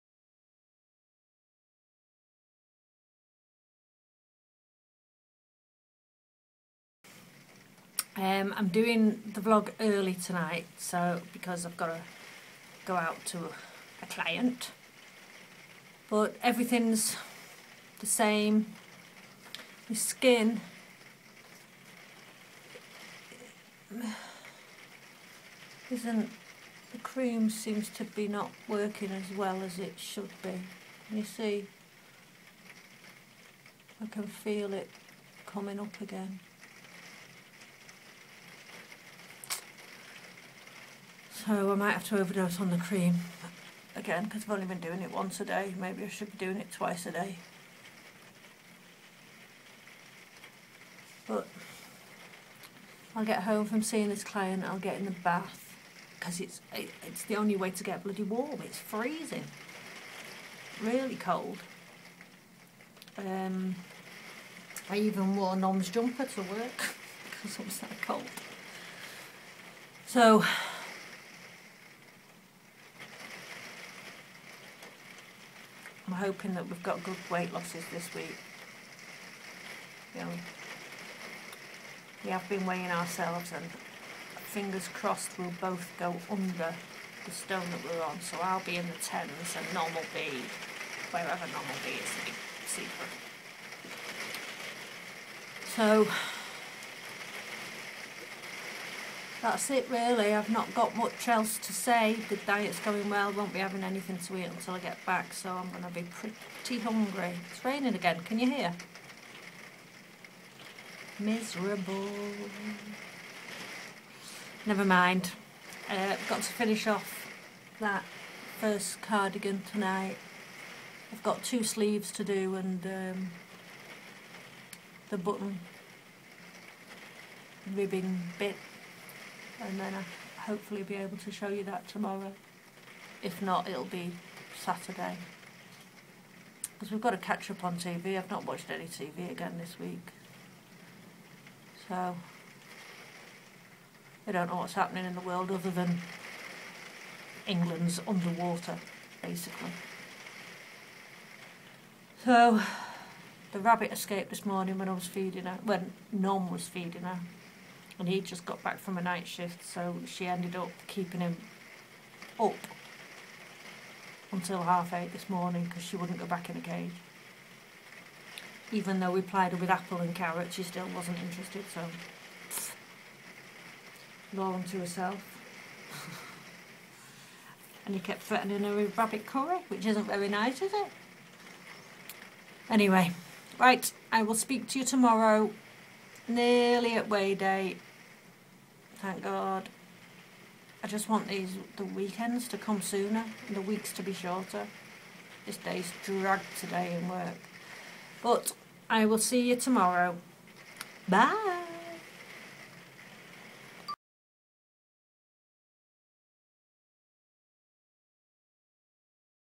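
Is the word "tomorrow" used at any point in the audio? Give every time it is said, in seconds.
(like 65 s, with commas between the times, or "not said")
131 s, 184 s, 199 s.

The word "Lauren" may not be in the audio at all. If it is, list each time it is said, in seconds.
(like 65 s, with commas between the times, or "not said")
174 s.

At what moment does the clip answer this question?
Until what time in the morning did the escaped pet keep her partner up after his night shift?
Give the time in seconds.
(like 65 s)
164 s.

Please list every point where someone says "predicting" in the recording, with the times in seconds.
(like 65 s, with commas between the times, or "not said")
not said.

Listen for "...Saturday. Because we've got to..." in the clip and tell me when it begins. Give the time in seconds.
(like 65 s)
134 s.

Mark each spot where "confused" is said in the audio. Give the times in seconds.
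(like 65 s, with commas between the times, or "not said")
not said.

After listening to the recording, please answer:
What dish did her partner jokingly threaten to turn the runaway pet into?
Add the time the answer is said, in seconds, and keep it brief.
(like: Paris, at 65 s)
rabbit curry, at 178 s.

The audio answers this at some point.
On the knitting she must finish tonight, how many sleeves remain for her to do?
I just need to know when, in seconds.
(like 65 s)
121 s.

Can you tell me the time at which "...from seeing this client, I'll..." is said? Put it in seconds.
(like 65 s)
53 s.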